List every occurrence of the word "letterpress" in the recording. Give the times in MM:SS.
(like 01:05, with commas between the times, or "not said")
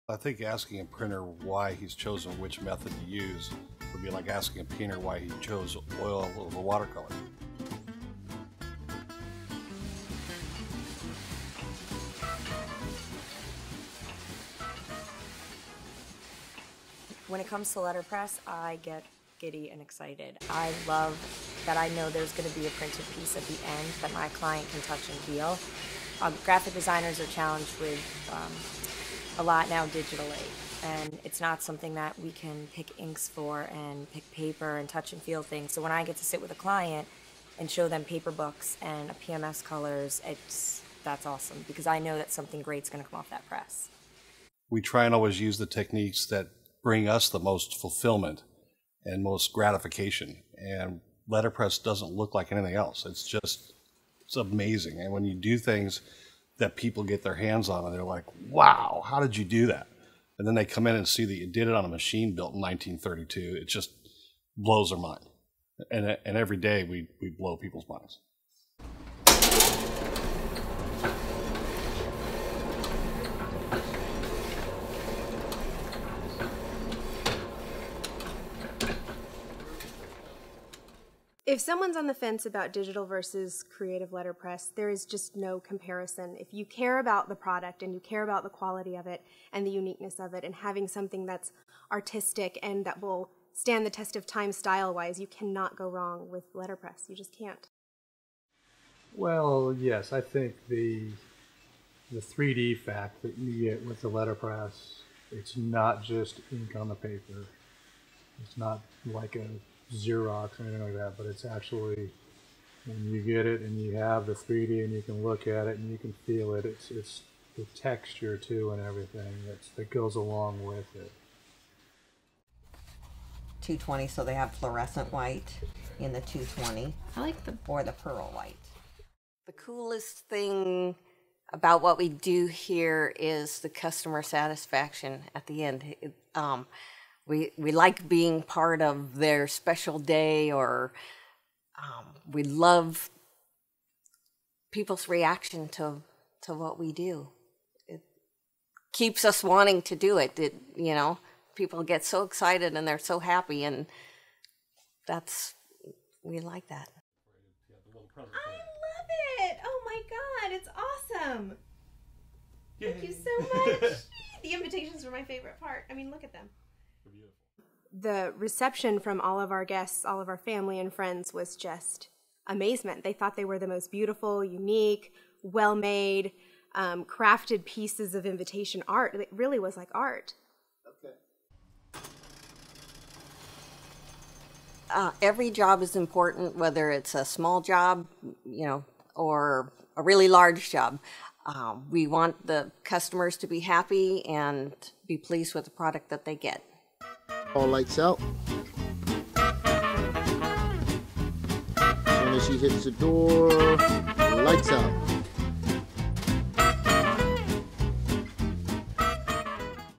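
00:17, 00:51, 01:24, 01:36, 01:44.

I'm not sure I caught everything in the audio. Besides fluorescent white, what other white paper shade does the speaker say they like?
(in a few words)
pearl white.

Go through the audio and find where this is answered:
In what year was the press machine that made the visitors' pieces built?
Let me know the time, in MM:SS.
01:02.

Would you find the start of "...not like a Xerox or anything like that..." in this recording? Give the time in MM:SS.
01:48.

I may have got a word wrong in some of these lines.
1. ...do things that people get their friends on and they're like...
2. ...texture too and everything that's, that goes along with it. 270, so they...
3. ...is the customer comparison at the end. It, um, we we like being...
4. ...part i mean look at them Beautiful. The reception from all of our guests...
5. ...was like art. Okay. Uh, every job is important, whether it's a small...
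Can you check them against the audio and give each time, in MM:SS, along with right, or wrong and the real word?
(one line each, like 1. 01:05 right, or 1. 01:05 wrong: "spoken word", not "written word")
1. 00:55 wrong: "hands", not "friends"
2. 01:57 wrong: "220", not "270"
3. 02:13 wrong: "satisfaction", not "comparison"
4. 02:45 right
5. 02:59 right.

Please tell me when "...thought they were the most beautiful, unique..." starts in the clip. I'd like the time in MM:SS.
02:53.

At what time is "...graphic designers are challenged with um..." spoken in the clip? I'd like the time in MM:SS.
00:26.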